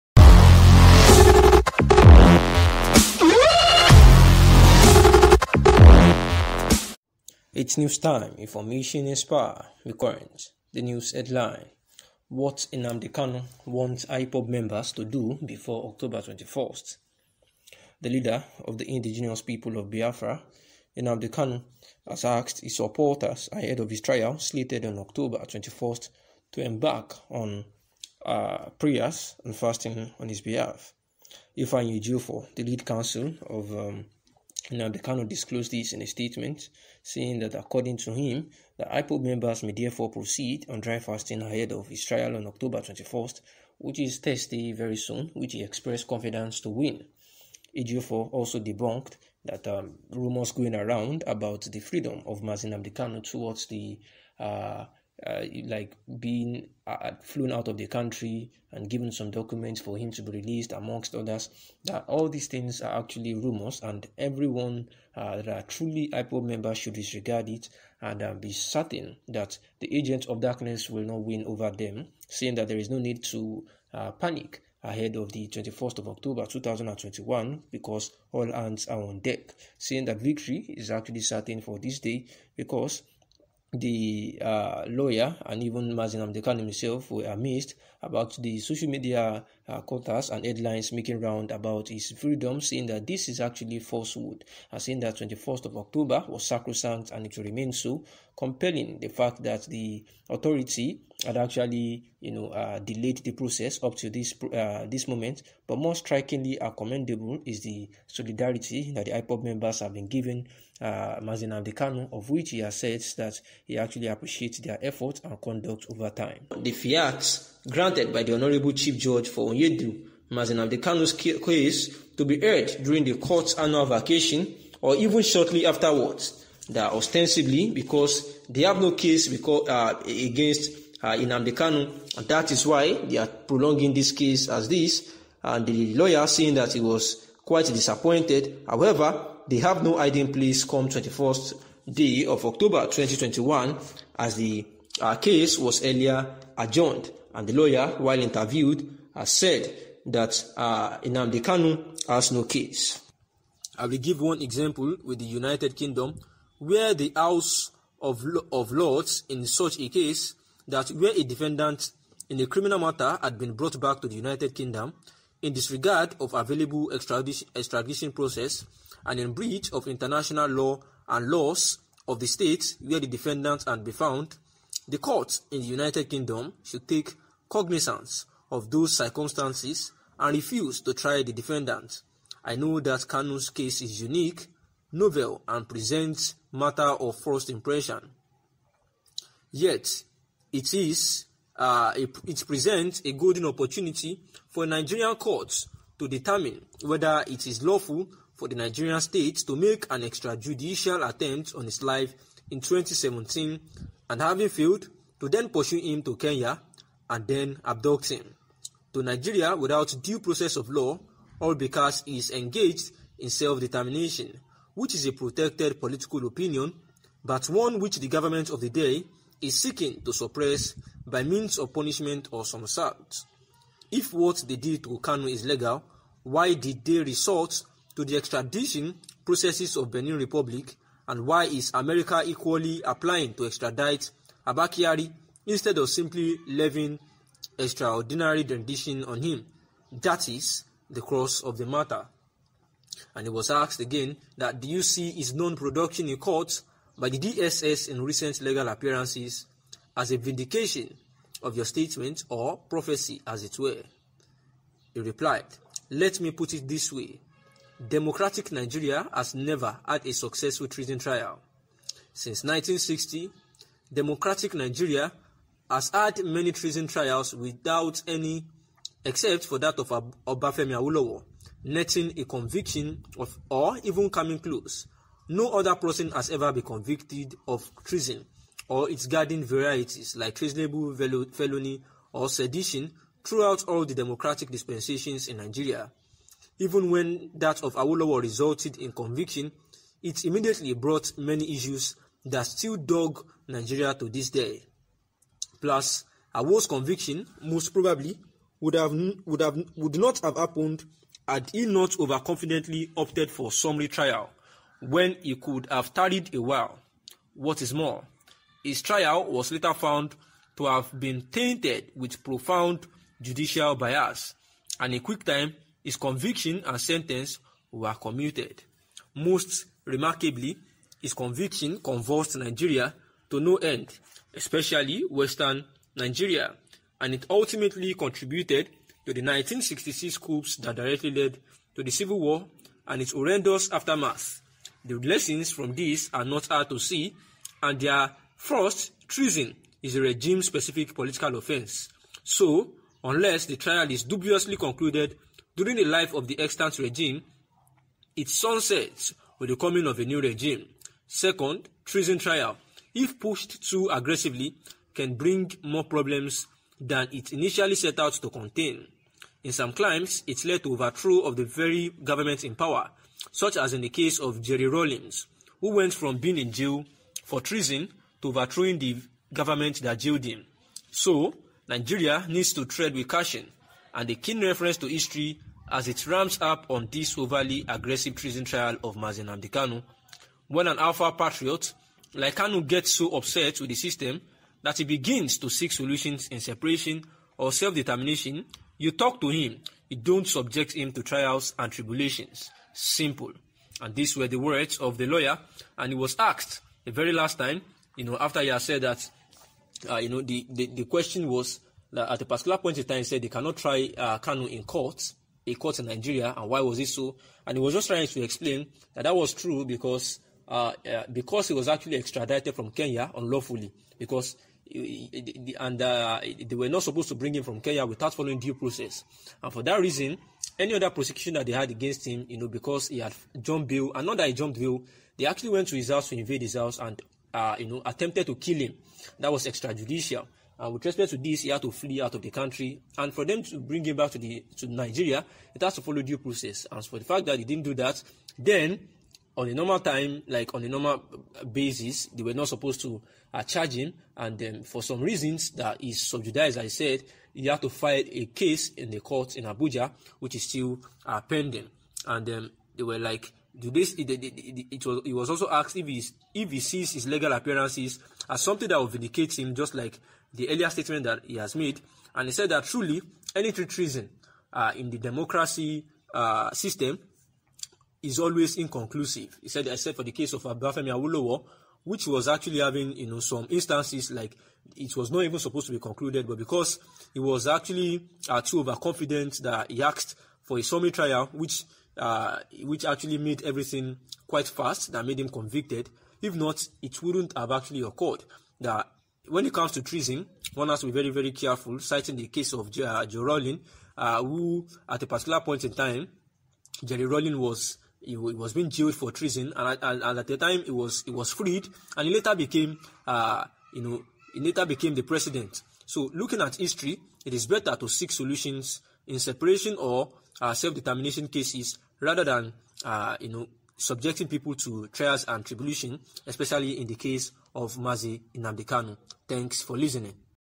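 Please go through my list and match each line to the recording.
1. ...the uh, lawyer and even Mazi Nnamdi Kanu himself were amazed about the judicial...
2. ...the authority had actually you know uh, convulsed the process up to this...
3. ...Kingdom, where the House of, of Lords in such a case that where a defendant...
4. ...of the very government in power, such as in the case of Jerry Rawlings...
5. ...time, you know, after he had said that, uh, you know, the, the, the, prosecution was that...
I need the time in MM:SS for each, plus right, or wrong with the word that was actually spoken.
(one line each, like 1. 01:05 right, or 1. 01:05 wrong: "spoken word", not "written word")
1. 01:23 wrong: "social", not "judicial"
2. 01:39 wrong: "delayed", not "convulsed"
3. 02:35 right
4. 06:01 right
5. 06:37 wrong: "question", not "prosecution".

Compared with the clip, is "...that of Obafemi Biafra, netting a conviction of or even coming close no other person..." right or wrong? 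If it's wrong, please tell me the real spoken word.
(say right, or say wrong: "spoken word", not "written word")
wrong: "Awolowo", not "Biafra".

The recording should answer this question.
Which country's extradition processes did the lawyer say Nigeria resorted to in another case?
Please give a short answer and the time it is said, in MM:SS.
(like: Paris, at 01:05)
Benin Republic, at 03:49.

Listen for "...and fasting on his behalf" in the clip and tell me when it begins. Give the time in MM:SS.
00:29.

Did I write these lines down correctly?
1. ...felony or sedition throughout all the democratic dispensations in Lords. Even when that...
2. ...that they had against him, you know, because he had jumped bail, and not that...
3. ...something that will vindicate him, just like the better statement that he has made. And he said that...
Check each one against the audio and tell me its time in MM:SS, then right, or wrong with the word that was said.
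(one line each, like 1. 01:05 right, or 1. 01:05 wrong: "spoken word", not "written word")
1. 04:41 wrong: "Nigeria", not "Lords"
2. 07:01 right
3. 07:38 wrong: "earlier", not "better".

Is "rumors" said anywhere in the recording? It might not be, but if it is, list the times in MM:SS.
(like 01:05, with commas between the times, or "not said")
00:50, 01:03.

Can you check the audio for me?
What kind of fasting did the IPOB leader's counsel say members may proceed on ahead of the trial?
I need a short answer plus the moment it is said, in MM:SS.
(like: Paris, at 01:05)
Dry fasting, at 00:40.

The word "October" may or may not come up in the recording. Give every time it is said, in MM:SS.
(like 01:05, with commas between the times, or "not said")
00:15, 00:24, 00:42, 01:16, 01:35, 02:22.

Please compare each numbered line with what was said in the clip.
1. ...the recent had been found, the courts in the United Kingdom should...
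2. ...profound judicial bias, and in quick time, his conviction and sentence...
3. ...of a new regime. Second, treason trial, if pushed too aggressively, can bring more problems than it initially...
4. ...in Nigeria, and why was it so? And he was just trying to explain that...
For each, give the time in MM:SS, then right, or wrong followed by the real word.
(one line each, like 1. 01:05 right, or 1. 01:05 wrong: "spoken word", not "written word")
1. 02:52 wrong: "defendant", not "recent"
2. 05:12 right
3. 05:49 right
4. 06:45 right.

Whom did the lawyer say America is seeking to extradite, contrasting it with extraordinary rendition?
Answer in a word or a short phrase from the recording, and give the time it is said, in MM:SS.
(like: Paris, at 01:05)
Abba Kyari, at 03:54.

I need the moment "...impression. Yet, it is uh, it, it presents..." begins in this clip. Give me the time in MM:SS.
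03:07.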